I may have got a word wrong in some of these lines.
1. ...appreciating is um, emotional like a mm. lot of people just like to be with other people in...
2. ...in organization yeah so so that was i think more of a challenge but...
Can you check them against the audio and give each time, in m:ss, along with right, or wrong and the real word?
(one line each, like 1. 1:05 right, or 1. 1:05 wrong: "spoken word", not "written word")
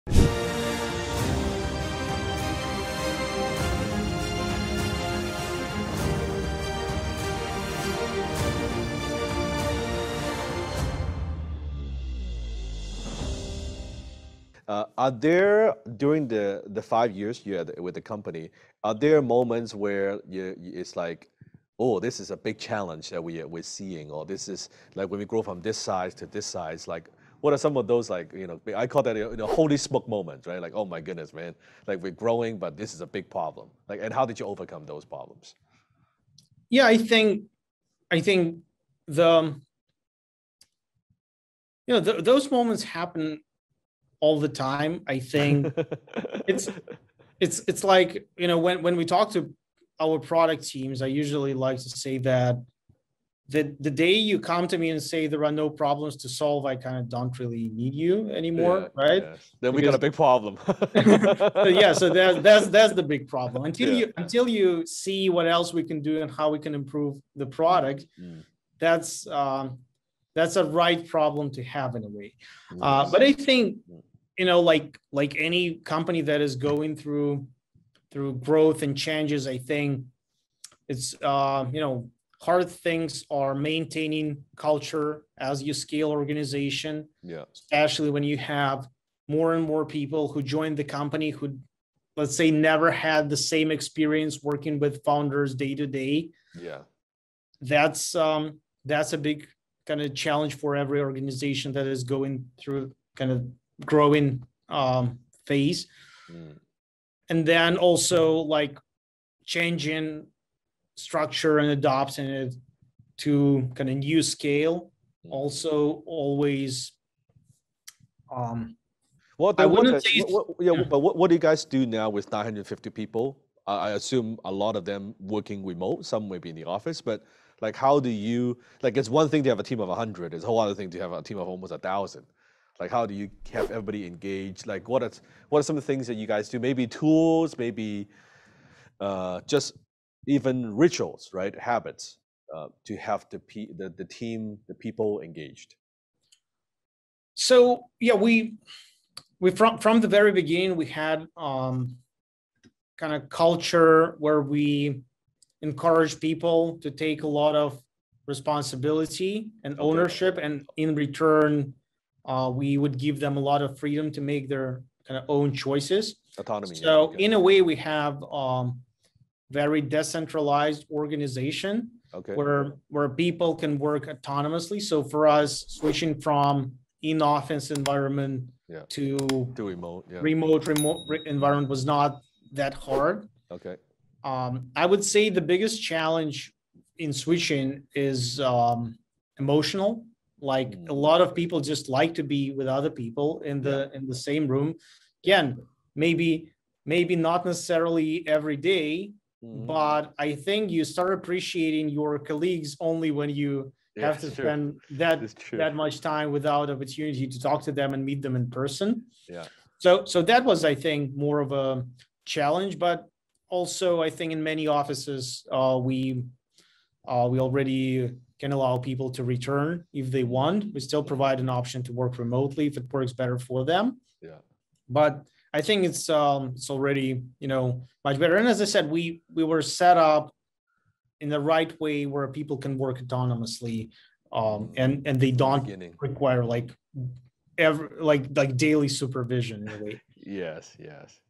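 1. 3:07 wrong: "switching", not "appreciating"
2. 3:28 wrong: "person", not "organization".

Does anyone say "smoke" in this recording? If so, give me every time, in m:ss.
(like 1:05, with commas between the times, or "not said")
0:29.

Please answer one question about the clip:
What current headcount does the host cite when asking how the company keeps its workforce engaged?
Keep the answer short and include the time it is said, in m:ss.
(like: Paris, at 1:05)
950, at 2:02.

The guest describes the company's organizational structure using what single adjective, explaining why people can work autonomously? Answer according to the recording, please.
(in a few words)
decentralized.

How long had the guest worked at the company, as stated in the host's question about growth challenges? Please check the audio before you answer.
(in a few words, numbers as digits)
5 years.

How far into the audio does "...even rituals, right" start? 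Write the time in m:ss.
2:20.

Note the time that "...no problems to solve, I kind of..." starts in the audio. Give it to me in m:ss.
0:55.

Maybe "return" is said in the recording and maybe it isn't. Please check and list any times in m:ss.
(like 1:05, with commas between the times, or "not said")
2:40, 3:39.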